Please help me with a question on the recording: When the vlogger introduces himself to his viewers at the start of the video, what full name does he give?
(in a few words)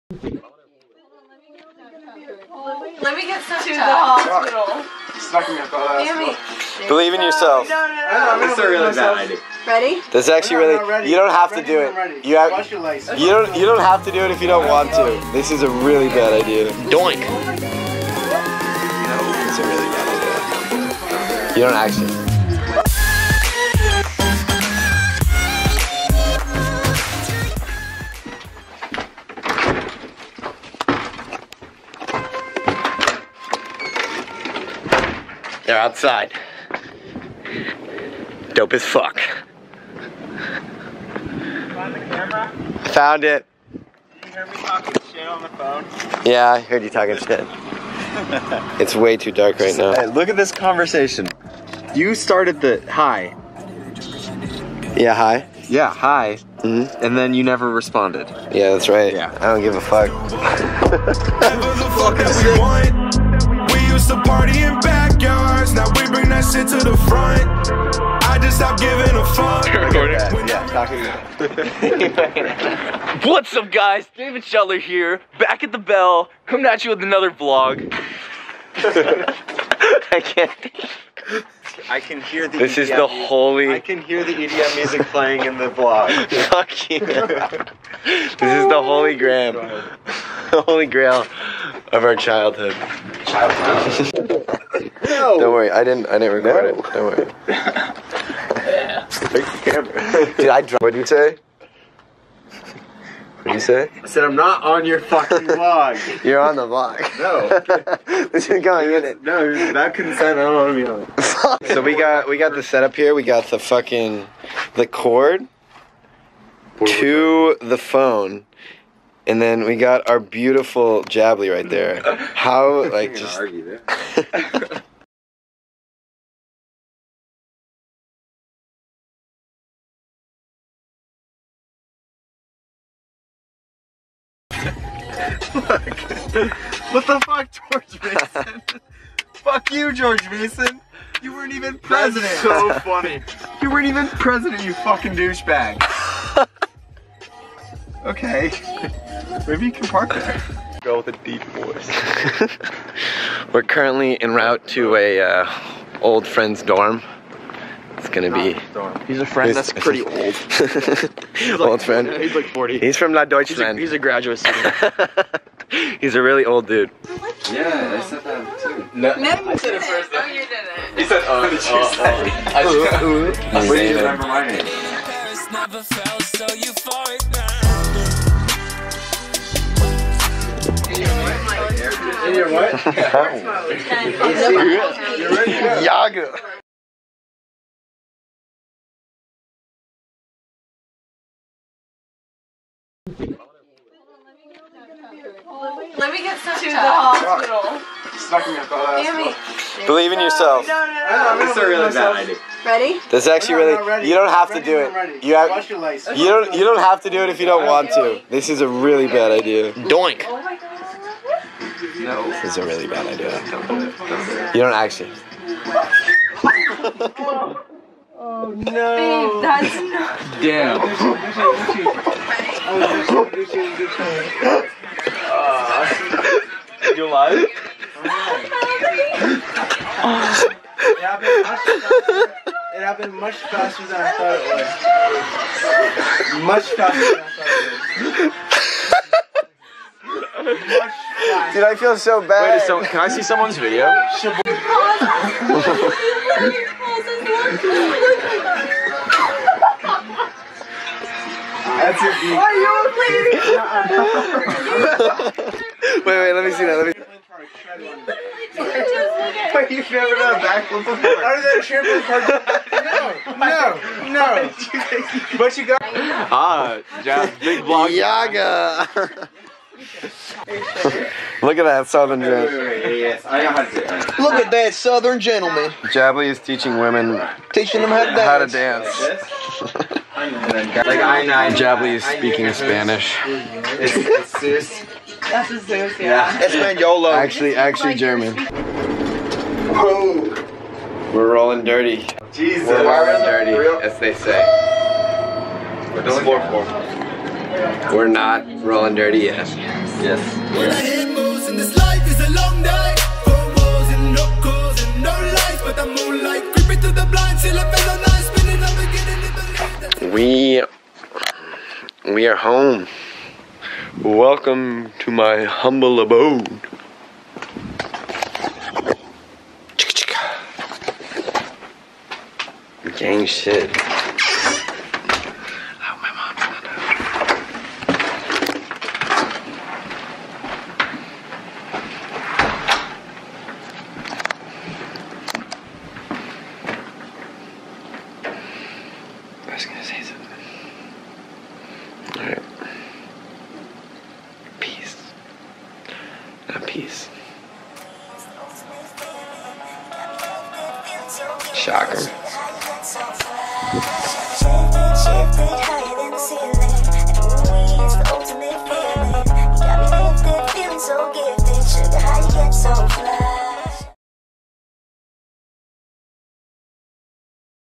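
David Shutler.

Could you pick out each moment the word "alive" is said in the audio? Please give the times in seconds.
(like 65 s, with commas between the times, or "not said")
227 s.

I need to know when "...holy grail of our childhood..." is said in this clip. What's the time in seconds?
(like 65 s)
90 s.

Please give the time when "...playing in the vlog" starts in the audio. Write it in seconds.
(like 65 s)
85 s.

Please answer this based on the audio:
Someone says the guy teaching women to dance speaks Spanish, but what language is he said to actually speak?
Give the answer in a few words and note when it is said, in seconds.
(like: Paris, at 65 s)
German, at 287 s.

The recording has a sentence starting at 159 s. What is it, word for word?
He's a friend he's, that's pretty old.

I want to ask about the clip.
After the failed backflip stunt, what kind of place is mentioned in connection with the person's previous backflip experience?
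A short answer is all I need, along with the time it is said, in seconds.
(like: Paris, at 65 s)
Trampoline park, at 261 s.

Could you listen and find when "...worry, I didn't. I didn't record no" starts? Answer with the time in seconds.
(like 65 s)
95 s.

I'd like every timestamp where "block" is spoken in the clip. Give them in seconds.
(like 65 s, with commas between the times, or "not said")
267 s.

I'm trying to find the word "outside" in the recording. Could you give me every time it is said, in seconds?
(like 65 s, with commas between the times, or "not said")
35 s.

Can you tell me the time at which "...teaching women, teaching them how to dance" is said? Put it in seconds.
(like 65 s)
276 s.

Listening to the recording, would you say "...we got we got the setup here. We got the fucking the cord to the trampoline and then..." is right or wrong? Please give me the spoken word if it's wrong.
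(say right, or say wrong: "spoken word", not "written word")
wrong: "phone", not "trampoline".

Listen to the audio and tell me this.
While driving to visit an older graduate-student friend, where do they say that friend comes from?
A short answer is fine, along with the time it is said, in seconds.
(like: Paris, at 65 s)
La Deutschland, at 163 s.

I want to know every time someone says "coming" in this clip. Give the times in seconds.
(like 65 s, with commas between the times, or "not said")
76 s.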